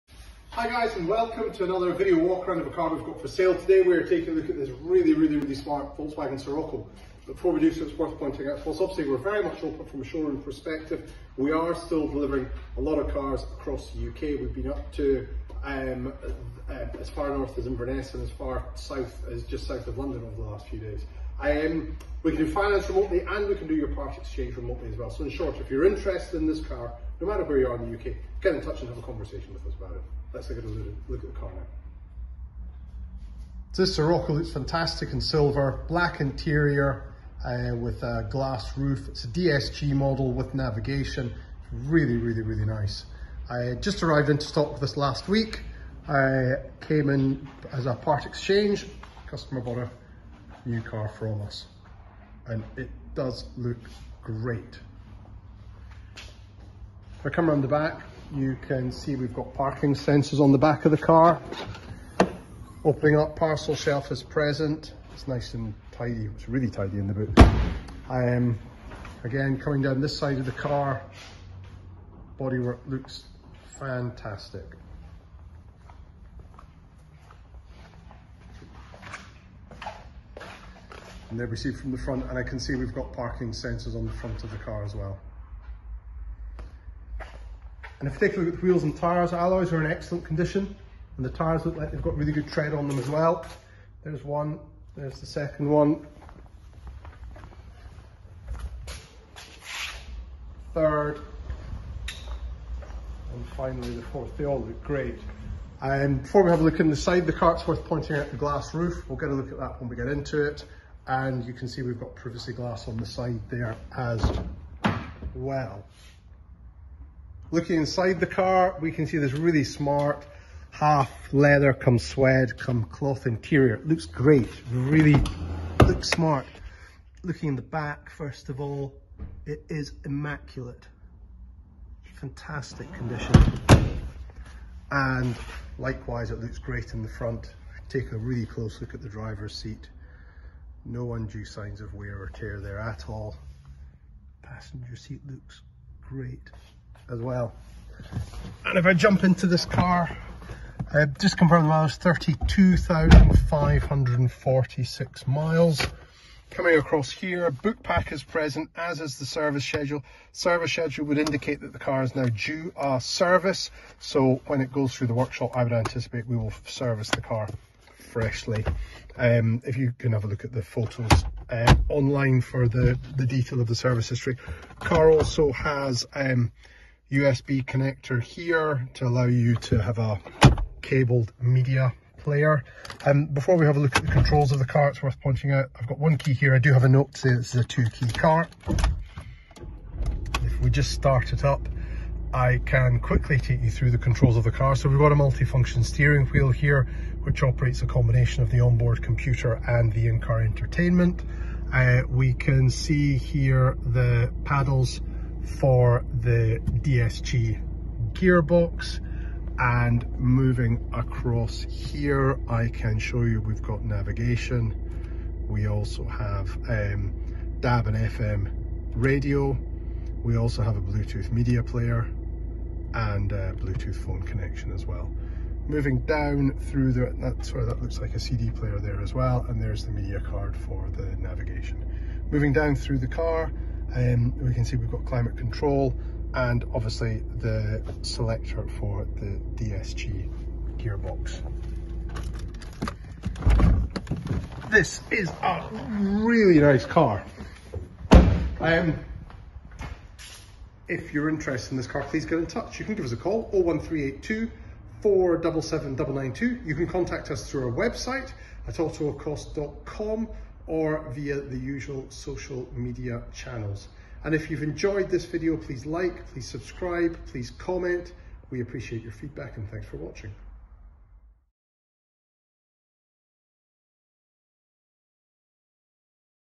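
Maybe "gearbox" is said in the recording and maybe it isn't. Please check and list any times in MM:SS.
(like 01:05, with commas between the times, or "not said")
03:28, 04:00.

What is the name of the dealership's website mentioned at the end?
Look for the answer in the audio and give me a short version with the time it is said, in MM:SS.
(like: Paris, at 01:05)
autoecosse.com, at 04:18.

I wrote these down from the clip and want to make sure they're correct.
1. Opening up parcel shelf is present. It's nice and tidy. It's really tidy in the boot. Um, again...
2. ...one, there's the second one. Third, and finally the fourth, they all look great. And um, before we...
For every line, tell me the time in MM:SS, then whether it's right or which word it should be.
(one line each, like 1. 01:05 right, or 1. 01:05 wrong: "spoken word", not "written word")
1. 01:02 right
2. 01:34 right.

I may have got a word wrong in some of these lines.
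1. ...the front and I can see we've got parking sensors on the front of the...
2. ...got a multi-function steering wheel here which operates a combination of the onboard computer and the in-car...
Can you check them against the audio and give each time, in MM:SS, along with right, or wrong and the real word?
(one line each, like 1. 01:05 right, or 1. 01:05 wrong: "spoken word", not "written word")
1. 01:21 right
2. 03:14 right.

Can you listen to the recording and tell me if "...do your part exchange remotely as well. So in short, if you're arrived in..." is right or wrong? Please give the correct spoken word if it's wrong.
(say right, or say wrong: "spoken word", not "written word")
wrong: "interested", not "arrived".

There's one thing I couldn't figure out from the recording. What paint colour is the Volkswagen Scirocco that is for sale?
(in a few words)
Silver.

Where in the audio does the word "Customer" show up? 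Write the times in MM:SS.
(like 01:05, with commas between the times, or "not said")
00:49.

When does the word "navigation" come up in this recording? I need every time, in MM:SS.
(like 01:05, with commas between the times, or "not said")
00:40, 03:33, 03:51.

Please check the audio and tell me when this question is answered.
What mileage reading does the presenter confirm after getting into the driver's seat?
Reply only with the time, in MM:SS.
02:31.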